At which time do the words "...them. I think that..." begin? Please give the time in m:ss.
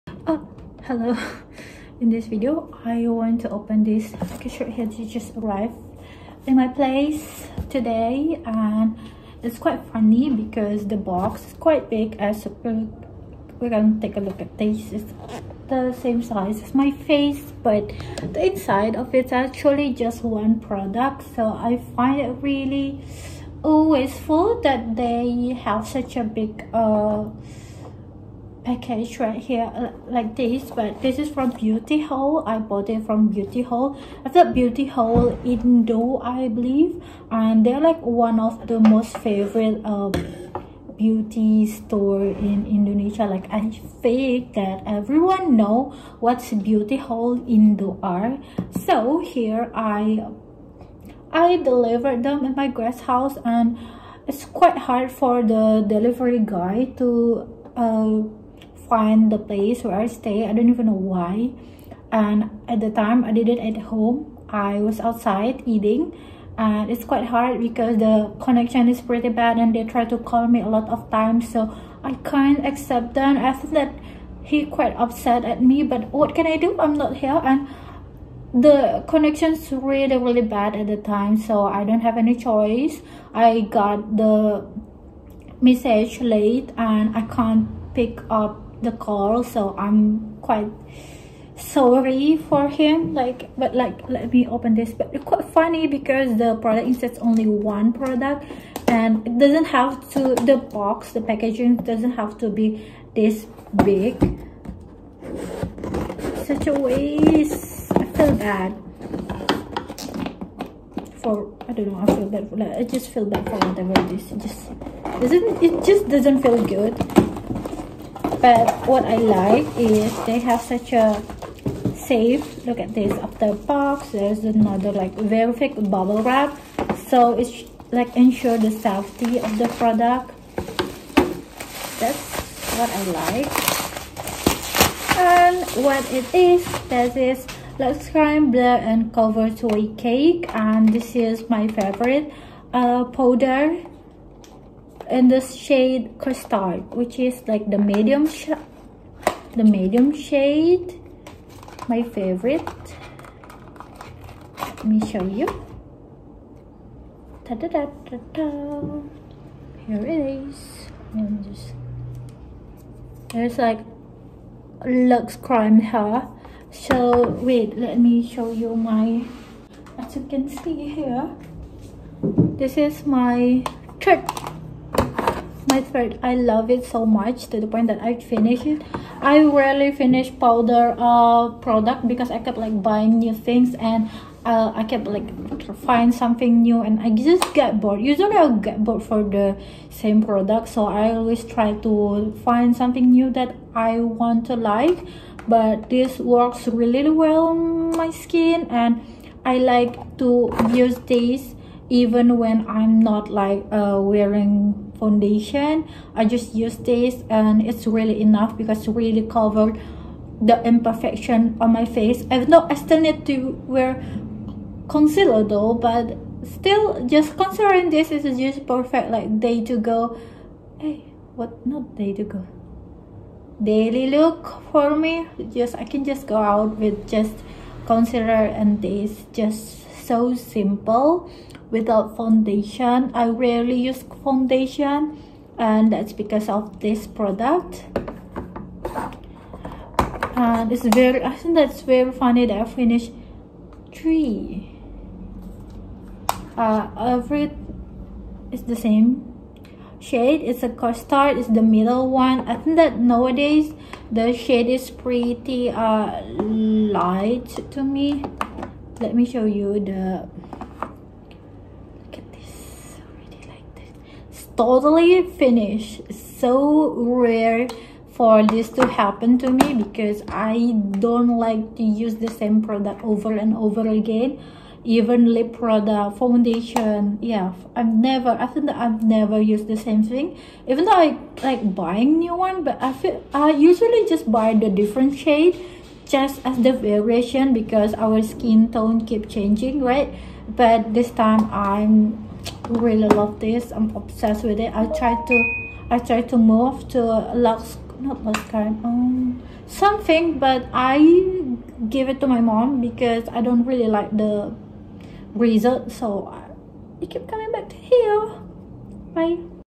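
1:13.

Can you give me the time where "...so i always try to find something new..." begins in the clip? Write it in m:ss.
3:10.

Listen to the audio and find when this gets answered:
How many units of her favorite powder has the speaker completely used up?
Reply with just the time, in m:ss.
4:02.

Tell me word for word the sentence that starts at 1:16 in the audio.
I'm not here and the connection's really really bad at the time so I don't have any choice.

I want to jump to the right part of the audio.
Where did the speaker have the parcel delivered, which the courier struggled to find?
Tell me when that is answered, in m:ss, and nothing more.
0:52.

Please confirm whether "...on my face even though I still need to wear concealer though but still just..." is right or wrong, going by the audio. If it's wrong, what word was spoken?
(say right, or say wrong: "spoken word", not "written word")
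right.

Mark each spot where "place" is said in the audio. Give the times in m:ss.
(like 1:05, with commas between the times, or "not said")
0:06, 0:59.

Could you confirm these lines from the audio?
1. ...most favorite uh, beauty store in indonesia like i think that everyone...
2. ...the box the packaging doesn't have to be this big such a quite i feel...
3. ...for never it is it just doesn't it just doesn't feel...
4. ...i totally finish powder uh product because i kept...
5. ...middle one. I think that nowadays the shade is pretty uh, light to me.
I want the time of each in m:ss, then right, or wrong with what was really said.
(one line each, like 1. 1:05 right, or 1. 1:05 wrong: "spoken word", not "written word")
1. 0:38 right
2. 1:40 wrong: "waste", not "quite"
3. 1:53 wrong: "whatever", not "never"
4. 2:59 wrong: "rarely", not "totally"
5. 4:11 right.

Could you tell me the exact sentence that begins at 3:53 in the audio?
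I rarely use foundation and that's because of this product.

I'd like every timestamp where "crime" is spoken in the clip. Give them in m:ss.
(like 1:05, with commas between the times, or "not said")
2:18, 2:45.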